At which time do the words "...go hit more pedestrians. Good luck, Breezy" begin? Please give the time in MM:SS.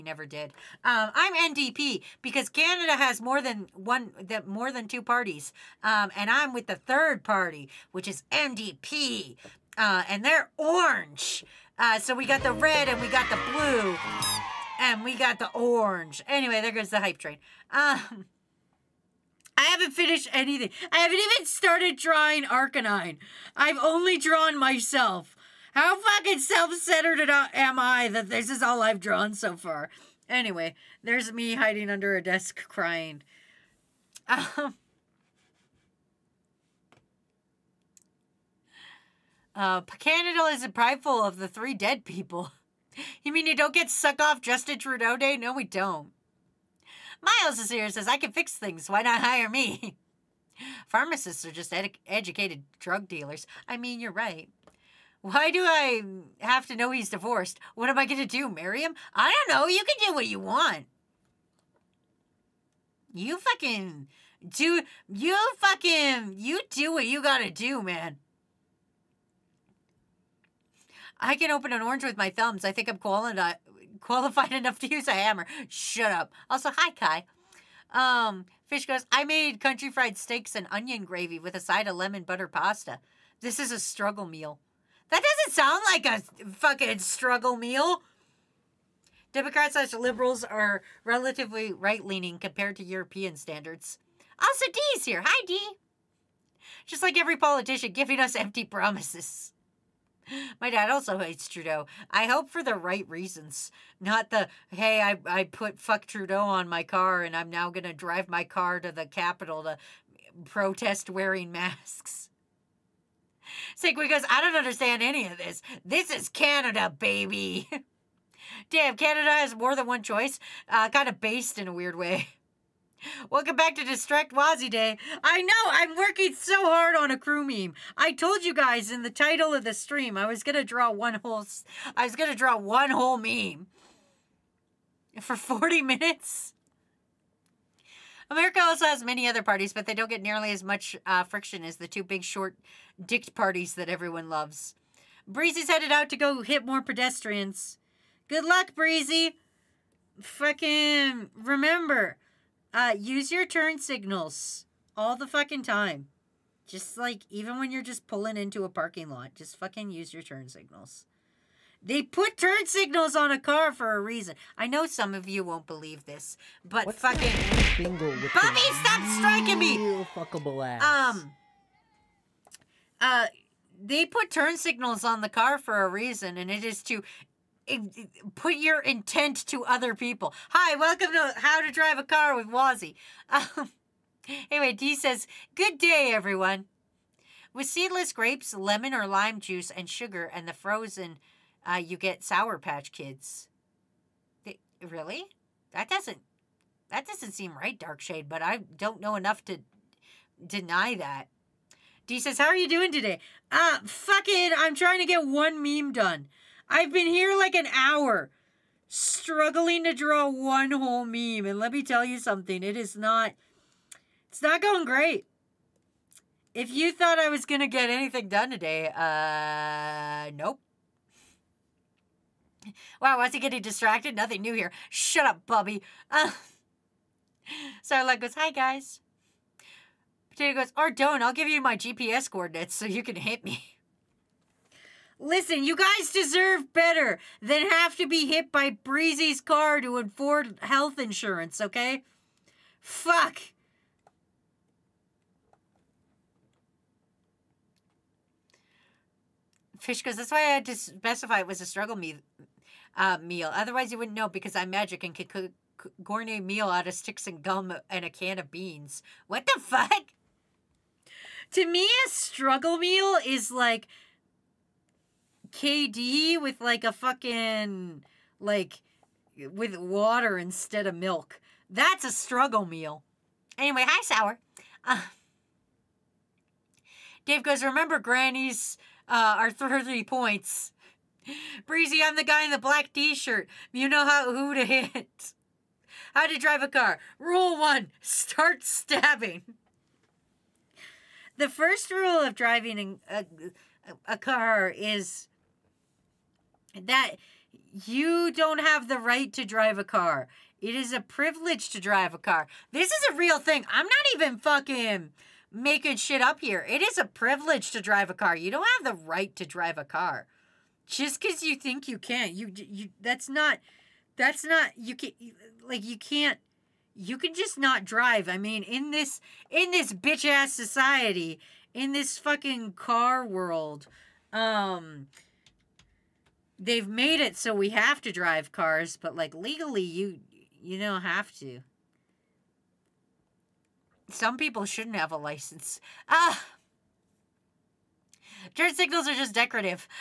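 02:26.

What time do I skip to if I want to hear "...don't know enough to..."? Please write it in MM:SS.
03:18.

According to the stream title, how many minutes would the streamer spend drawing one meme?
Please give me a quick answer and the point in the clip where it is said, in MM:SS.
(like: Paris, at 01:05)
40, at 02:15.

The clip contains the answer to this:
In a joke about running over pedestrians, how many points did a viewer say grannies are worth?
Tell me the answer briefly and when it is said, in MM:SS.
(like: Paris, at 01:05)
30, at 04:39.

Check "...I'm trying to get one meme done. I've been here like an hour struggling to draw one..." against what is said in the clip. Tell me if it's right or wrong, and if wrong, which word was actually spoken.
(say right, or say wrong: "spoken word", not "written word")
right.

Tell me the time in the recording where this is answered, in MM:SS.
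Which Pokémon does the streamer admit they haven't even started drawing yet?
00:22.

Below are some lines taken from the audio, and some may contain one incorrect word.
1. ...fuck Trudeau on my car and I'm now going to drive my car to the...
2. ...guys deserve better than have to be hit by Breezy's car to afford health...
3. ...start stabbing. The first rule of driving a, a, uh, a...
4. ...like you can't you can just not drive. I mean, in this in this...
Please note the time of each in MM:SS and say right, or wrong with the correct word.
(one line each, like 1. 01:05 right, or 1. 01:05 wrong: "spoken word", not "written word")
1. 01:45 right
2. 03:55 right
3. 04:48 right
4. 05:15 right.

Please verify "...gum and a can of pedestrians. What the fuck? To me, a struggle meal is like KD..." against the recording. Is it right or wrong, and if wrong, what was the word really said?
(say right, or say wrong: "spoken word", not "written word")
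wrong: "beans", not "pedestrians".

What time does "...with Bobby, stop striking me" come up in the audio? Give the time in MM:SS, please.
02:47.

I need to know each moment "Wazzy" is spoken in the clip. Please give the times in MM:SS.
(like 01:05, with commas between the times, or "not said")
02:04, 03:02.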